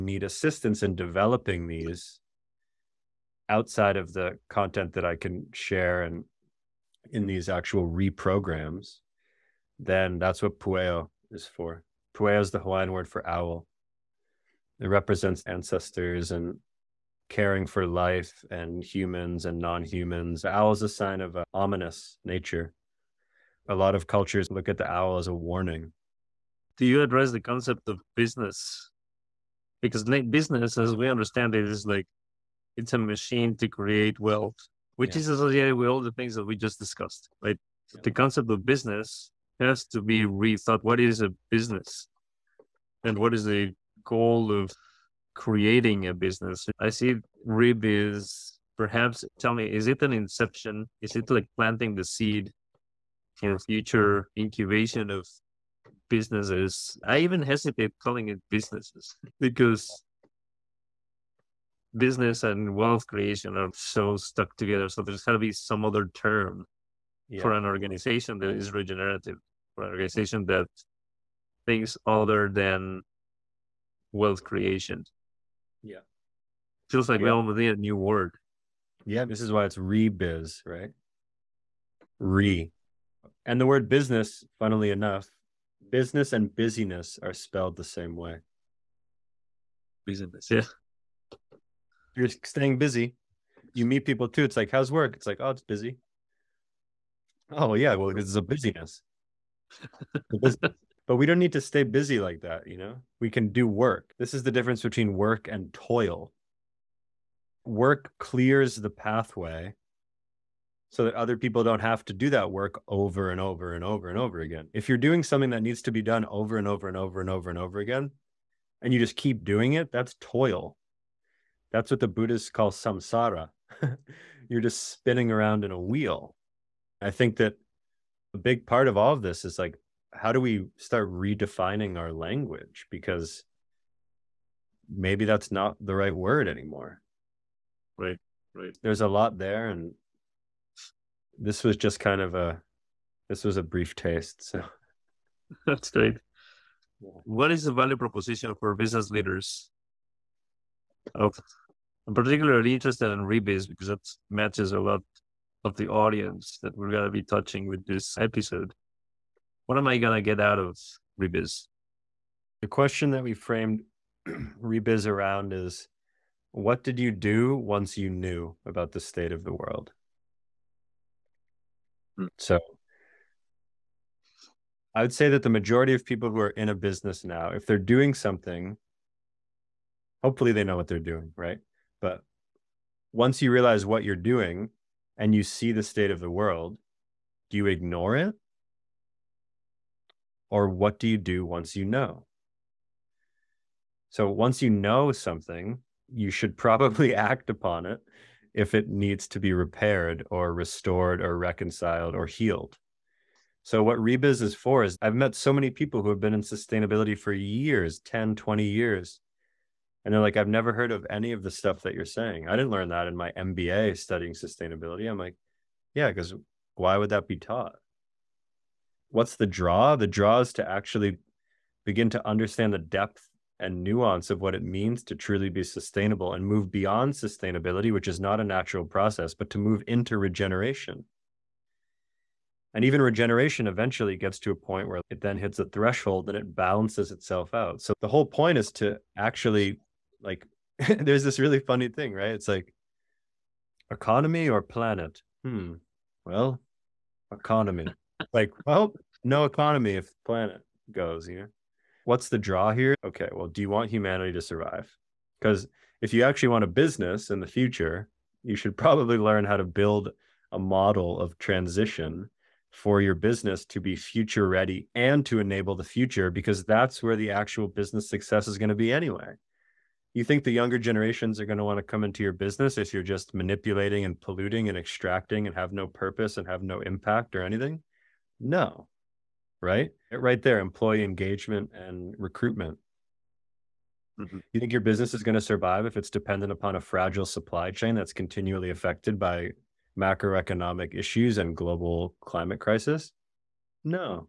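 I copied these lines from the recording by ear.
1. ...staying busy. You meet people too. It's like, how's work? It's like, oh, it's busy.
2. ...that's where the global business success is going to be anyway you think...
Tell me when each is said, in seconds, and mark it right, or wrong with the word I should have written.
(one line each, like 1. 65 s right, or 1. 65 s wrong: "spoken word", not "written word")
1. 92 s right
2. 266 s wrong: "actual", not "global".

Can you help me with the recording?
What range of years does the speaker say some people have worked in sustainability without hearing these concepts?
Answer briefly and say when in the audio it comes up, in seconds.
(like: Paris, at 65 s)
10, 20 years, at 207 s.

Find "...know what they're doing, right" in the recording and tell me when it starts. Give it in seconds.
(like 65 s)
180 s.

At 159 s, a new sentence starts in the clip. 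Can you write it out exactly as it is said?
What am I going to get out of Rebiz?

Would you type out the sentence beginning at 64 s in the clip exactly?
So there's got to be some other term yeah.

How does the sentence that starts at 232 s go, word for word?
And even regeneration eventually gets to a point where it then hits a threshold and it balances itself out.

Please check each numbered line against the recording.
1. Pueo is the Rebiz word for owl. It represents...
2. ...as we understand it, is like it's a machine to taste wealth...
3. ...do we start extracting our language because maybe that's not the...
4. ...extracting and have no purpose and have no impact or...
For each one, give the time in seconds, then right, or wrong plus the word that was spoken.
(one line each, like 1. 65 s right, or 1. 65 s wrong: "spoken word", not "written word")
1. 12 s wrong: "Hawaiian", not "Rebiz"
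2. 30 s wrong: "create", not "taste"
3. 130 s wrong: "redefining", not "extracting"
4. 274 s right.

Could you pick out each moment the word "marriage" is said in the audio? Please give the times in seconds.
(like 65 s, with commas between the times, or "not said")
not said.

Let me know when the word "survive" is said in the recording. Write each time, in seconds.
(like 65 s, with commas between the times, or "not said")
254 s, 285 s.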